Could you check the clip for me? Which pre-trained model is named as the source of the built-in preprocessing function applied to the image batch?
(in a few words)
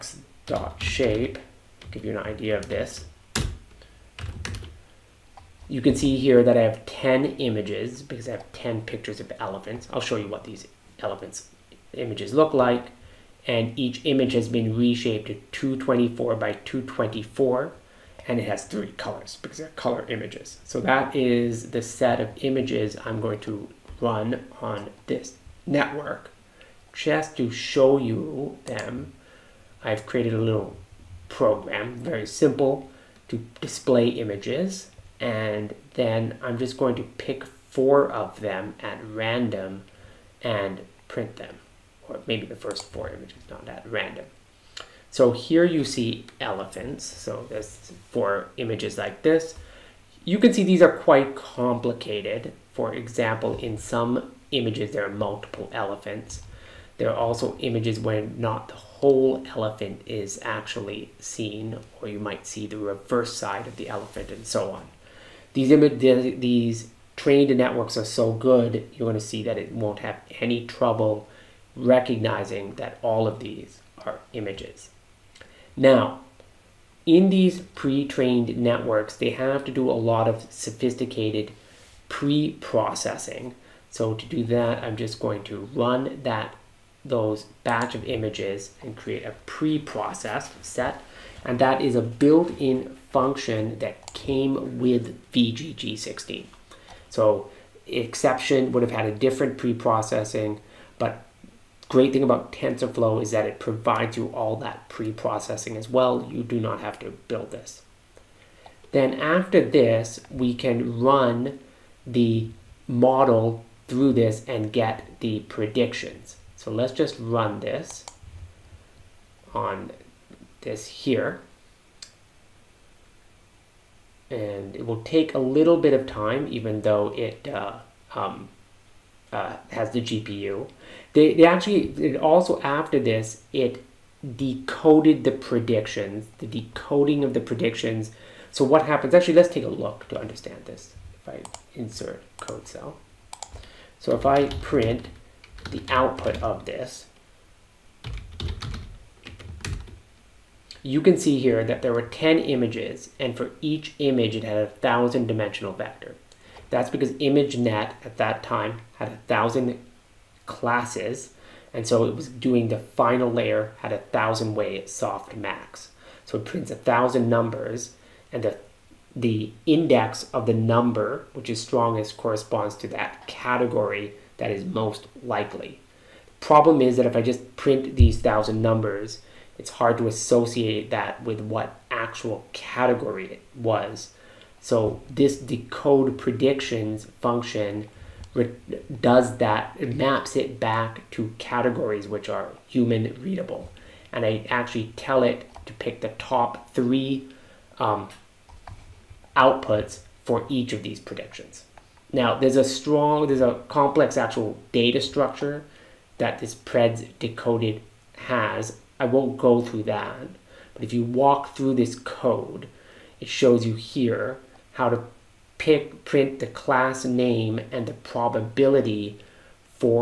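VGG16.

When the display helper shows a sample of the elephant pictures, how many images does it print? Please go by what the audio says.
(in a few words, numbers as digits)
4.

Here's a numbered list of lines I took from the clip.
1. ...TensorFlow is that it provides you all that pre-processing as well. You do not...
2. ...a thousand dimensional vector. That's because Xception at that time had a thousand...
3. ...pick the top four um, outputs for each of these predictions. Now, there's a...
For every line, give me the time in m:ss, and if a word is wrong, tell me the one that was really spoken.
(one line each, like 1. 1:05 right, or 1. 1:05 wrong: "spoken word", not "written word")
1. 1:42 right
2. 2:34 wrong: "ImageNet", not "Xception"
3. 3:15 wrong: "three", not "four".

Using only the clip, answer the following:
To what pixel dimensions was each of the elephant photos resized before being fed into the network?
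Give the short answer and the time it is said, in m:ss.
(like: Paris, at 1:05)
224 by 224, at 0:15.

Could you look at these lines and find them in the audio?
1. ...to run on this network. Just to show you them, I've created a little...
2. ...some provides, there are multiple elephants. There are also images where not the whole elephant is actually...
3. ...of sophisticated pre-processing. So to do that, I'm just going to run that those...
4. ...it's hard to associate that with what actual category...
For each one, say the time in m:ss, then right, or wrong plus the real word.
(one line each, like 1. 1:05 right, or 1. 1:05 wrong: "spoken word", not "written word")
1. 0:23 right
2. 0:53 wrong: "images", not "provides"
3. 1:20 right
4. 2:59 right.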